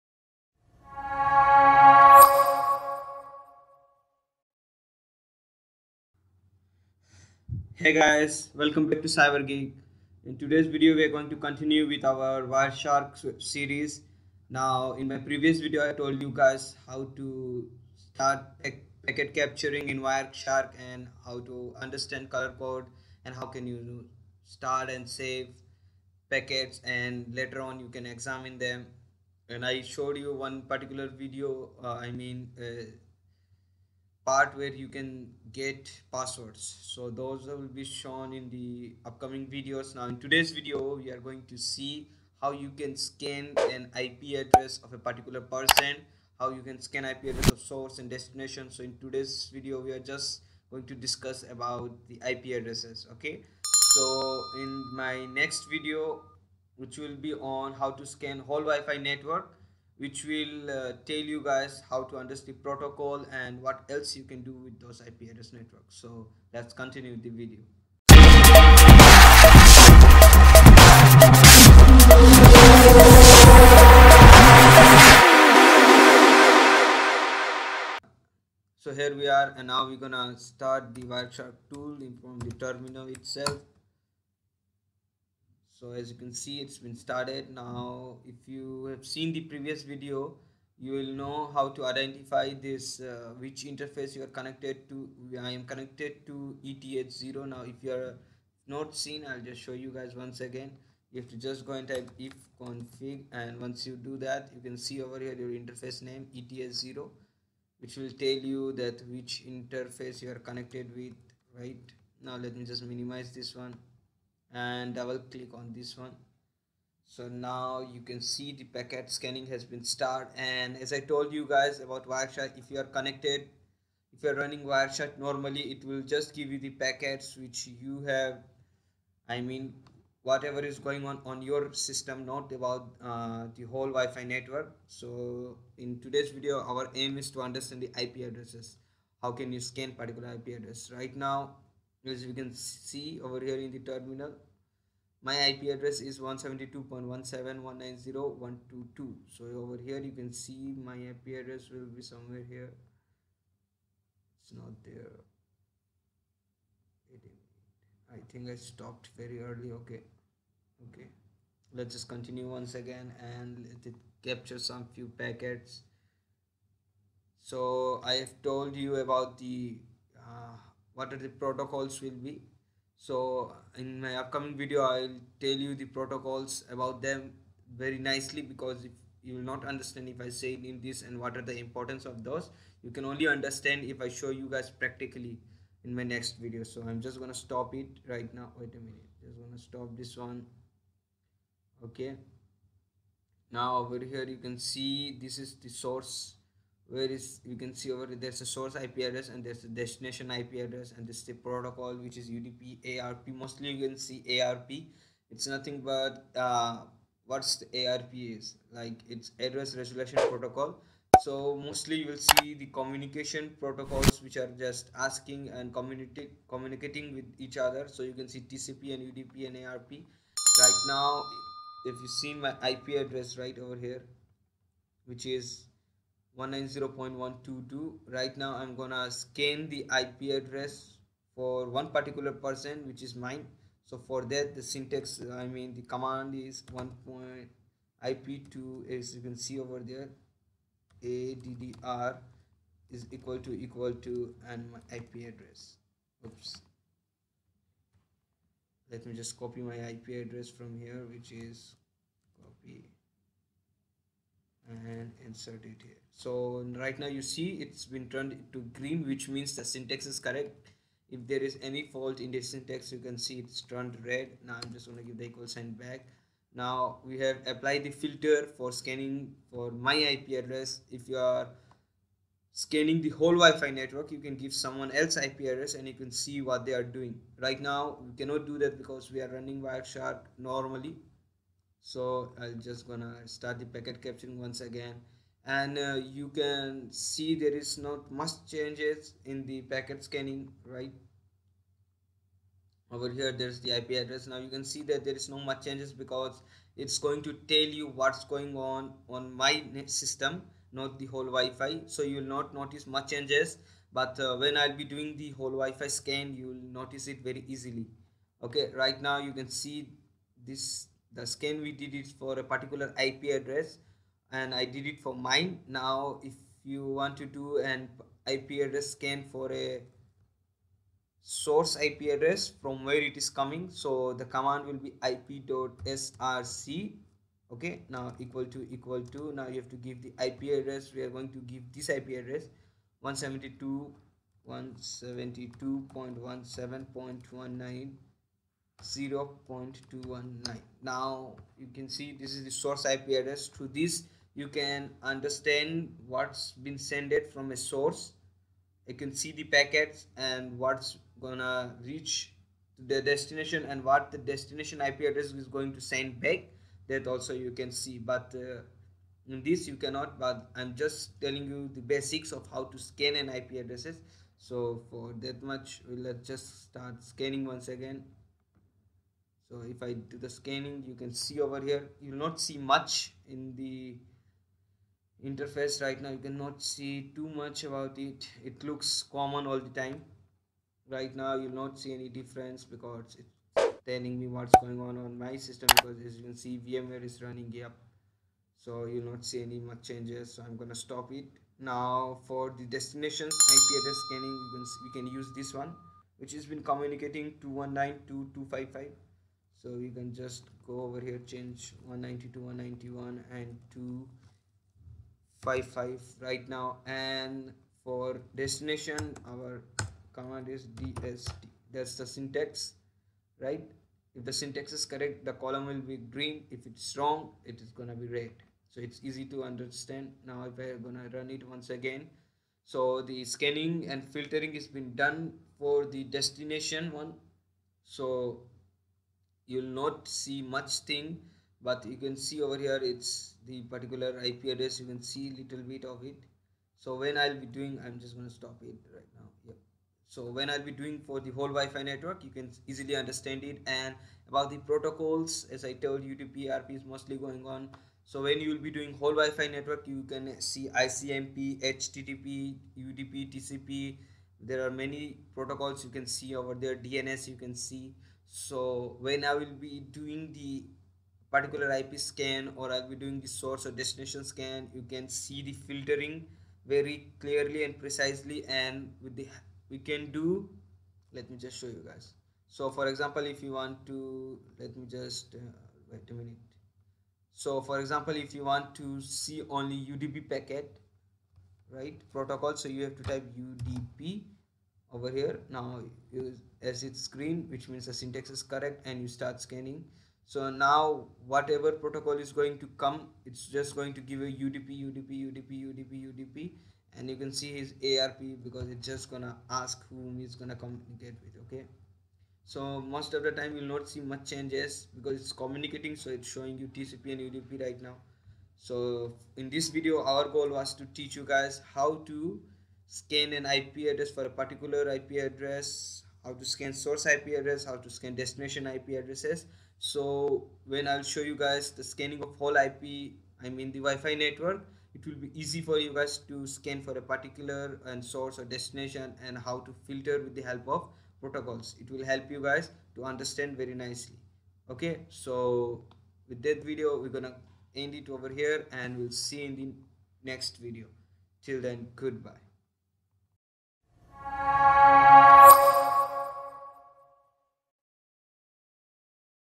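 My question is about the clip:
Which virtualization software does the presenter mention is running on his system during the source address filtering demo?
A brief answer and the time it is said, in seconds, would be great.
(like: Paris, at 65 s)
VMware, at 386 s.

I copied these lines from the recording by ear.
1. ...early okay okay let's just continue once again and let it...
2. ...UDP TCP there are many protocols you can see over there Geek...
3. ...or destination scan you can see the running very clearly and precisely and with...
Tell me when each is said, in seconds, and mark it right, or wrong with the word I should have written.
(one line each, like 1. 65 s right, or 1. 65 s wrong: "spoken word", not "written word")
1. 159 s right
2. 452 s wrong: "DNS", not "Geek"
3. 463 s wrong: "filtering", not "running".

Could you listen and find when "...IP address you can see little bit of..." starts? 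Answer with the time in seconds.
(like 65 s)
434 s.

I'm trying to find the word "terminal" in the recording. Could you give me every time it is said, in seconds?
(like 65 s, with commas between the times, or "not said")
82 s, 143 s.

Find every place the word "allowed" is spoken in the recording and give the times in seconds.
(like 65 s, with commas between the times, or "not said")
not said.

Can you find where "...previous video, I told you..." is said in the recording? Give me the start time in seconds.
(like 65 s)
15 s.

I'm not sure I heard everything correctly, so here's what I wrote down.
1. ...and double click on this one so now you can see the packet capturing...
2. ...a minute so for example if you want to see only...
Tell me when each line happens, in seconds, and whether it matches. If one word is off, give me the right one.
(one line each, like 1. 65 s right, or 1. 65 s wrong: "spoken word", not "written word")
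1. 114 s wrong: "scanning", not "capturing"
2. 476 s right.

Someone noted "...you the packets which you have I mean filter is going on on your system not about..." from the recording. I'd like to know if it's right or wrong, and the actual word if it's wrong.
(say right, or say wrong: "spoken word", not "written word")
wrong: "whatever", not "filter".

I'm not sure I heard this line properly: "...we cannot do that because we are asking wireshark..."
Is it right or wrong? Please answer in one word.
wrong.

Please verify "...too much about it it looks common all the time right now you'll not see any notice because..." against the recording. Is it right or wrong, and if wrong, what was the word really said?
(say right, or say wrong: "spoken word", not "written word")
wrong: "difference", not "notice".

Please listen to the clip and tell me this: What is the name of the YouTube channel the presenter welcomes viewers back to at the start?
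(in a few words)
Cyber Geek.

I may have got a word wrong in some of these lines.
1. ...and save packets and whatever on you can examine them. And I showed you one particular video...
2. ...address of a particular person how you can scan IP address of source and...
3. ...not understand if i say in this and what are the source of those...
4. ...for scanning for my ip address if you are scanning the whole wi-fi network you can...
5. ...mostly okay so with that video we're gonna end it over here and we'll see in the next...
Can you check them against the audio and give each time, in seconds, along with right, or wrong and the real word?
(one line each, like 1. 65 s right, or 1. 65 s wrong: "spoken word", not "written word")
1. 24 s wrong: "later", not "whatever"
2. 44 s right
3. 179 s wrong: "importance", not "source"
4. 268 s right
5. 533 s wrong: "nicely", not "mostly".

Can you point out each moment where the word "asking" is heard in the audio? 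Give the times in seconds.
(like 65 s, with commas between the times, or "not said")
214 s.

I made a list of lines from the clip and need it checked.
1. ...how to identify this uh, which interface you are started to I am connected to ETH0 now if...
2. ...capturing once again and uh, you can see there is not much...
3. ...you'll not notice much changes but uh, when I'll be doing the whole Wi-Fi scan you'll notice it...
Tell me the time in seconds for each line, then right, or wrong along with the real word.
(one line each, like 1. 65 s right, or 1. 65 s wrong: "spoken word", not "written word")
1. 91 s wrong: "connected", not "started"
2. 284 s right
3. 302 s right.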